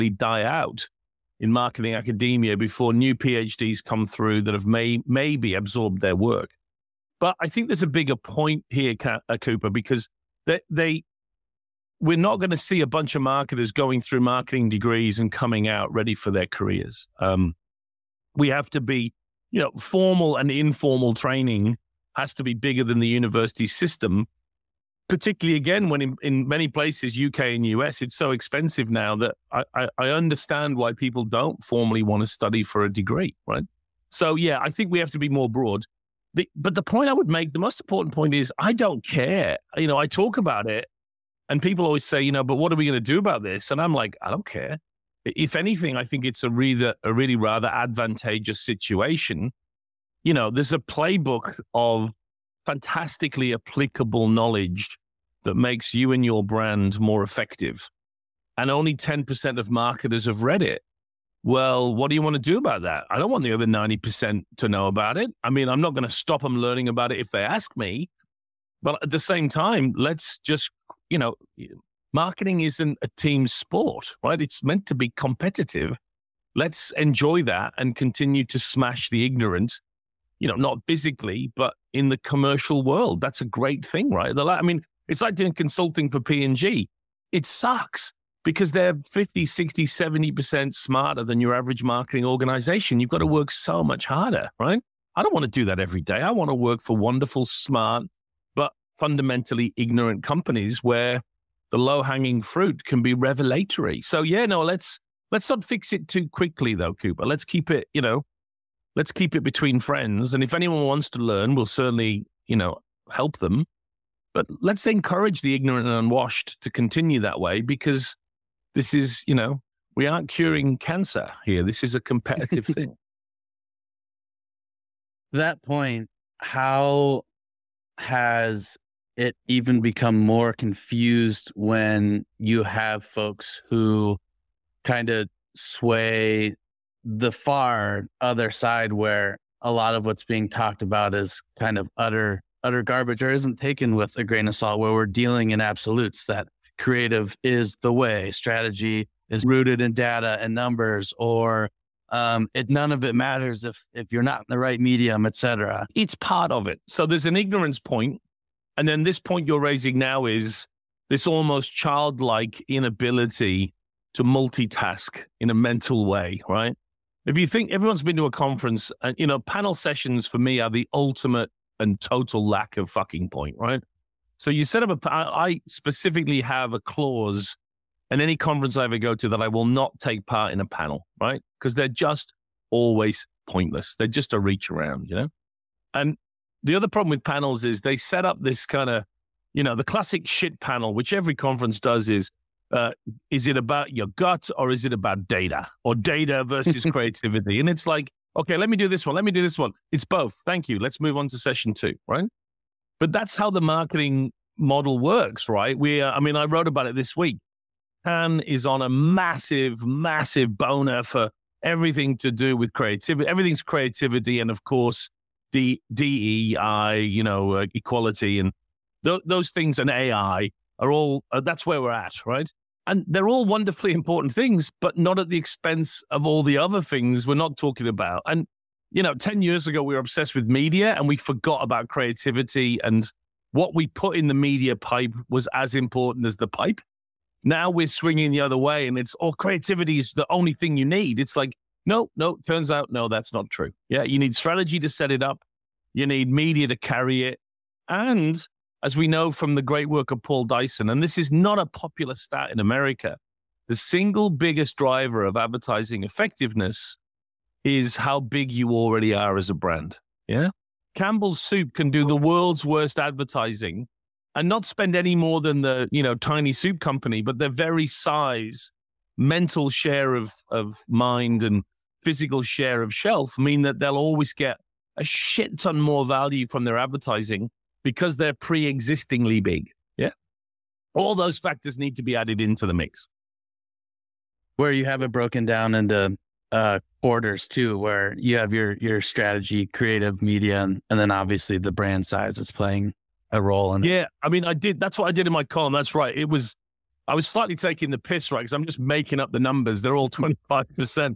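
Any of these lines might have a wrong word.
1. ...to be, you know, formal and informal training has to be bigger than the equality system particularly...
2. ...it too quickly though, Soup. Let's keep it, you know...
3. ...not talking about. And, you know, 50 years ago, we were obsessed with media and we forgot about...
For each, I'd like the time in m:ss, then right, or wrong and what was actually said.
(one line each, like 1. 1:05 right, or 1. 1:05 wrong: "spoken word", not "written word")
1. 0:18 wrong: "university", not "equality"
2. 1:45 wrong: "Cooper", not "Soup"
3. 3:47 wrong: "10", not "50".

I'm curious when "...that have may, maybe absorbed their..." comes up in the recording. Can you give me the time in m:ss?
0:04.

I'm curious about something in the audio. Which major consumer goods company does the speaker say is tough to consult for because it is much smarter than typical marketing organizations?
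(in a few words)
P&G.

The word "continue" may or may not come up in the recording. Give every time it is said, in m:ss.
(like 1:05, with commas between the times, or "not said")
1:17, 1:56.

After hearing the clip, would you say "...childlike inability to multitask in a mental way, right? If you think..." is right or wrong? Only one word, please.
right.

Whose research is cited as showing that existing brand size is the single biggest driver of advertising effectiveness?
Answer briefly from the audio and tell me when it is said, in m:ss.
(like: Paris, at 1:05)
Paul Dyson, at 4:10.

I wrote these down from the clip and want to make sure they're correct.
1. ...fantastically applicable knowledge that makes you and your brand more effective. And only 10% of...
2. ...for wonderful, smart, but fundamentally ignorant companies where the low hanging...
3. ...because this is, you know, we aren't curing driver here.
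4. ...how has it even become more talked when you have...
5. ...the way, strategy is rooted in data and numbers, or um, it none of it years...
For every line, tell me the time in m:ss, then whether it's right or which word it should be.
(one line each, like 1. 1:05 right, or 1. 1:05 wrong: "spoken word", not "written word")
1. 0:52 right
2. 1:36 right
3. 1:57 wrong: "cancer", not "driver"
4. 2:06 wrong: "confused", not "talked"
5. 2:27 wrong: "matters", not "years".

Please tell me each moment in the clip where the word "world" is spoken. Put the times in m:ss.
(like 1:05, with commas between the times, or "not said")
1:22, 4:22.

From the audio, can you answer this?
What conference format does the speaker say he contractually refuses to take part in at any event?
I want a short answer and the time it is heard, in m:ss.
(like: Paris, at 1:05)
A panel, at 3:00.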